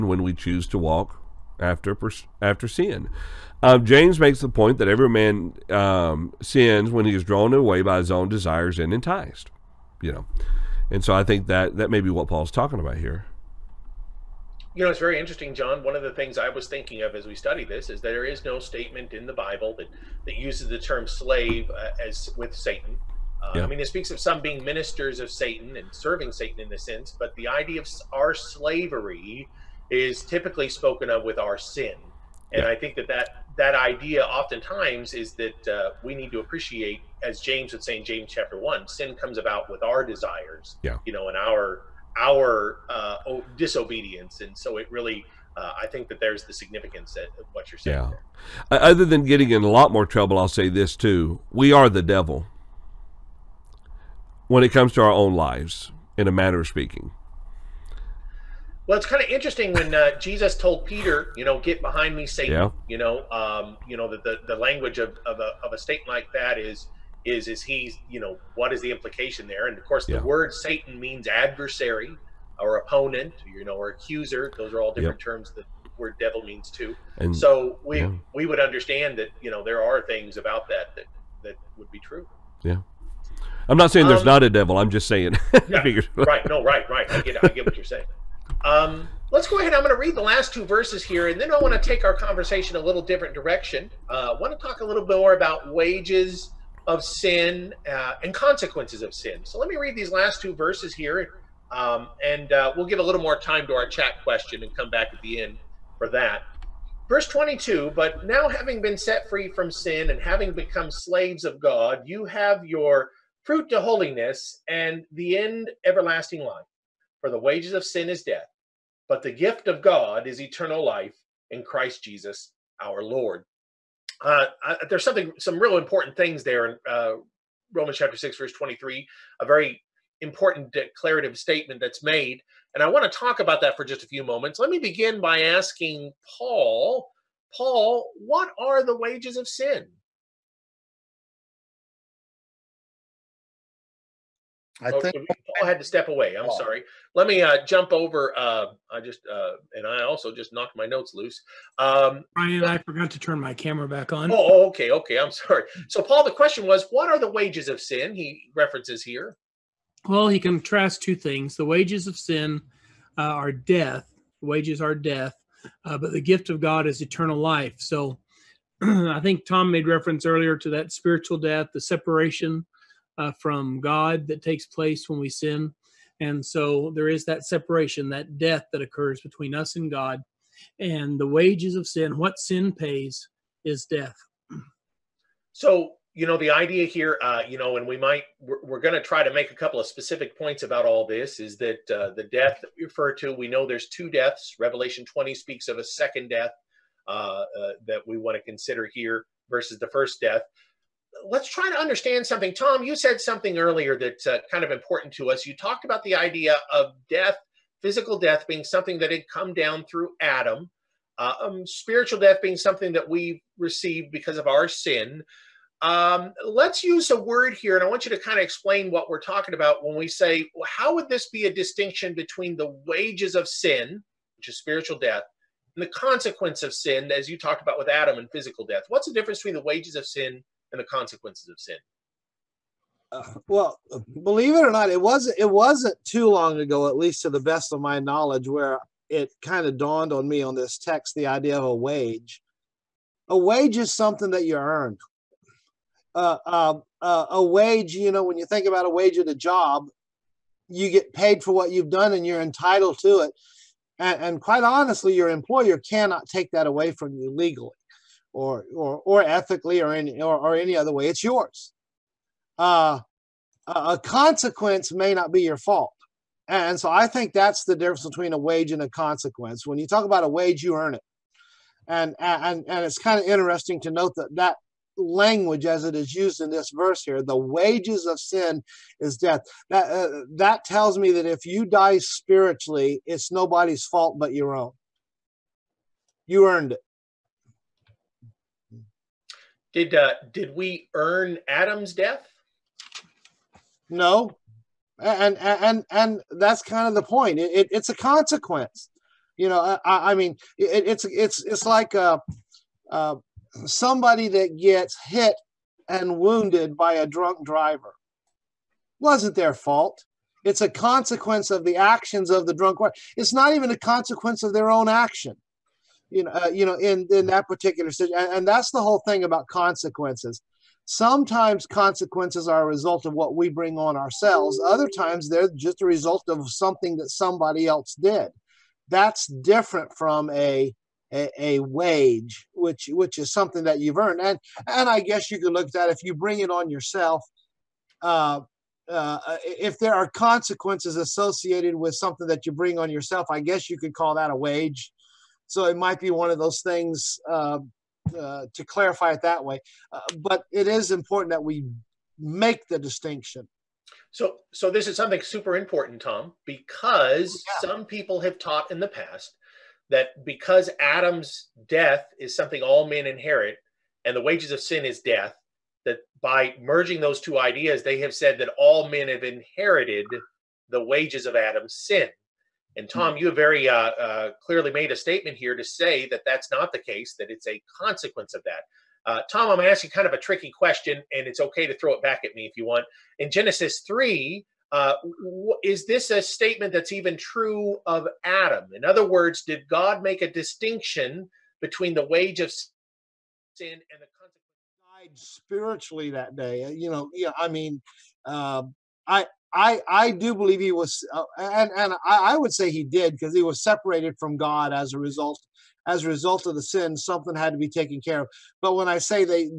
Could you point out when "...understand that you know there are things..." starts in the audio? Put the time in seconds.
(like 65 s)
78 s.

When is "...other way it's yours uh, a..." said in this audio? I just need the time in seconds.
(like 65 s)
260 s.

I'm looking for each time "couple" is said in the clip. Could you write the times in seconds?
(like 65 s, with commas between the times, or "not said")
189 s.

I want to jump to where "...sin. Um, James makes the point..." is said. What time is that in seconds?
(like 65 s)
2 s.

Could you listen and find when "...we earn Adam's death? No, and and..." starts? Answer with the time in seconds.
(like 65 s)
290 s.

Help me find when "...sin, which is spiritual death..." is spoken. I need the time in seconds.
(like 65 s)
223 s.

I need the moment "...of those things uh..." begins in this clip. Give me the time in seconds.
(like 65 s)
346 s.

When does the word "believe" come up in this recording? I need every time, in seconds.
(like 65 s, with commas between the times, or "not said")
234 s, 400 s.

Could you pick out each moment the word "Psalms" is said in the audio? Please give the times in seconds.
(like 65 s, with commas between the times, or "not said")
not said.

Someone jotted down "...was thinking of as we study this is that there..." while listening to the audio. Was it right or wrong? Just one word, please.
right.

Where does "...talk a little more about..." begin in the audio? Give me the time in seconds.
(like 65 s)
94 s.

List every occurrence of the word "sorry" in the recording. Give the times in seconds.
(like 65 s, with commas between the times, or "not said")
146 s, 155 s.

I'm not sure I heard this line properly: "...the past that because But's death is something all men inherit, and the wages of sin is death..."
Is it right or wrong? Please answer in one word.
wrong.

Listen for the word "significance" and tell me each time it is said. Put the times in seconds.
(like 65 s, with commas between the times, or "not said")
46 s.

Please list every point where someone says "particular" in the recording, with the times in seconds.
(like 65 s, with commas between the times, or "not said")
317 s.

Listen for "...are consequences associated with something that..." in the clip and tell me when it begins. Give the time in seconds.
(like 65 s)
339 s.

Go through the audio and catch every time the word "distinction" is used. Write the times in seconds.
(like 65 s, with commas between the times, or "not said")
221 s, 352 s, 390 s.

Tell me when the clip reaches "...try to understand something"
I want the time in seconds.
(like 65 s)
201 s.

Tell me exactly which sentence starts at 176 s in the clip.
And so there is that separation, that death that occurs between us and God.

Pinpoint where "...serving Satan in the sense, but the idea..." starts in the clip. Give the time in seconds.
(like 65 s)
25 s.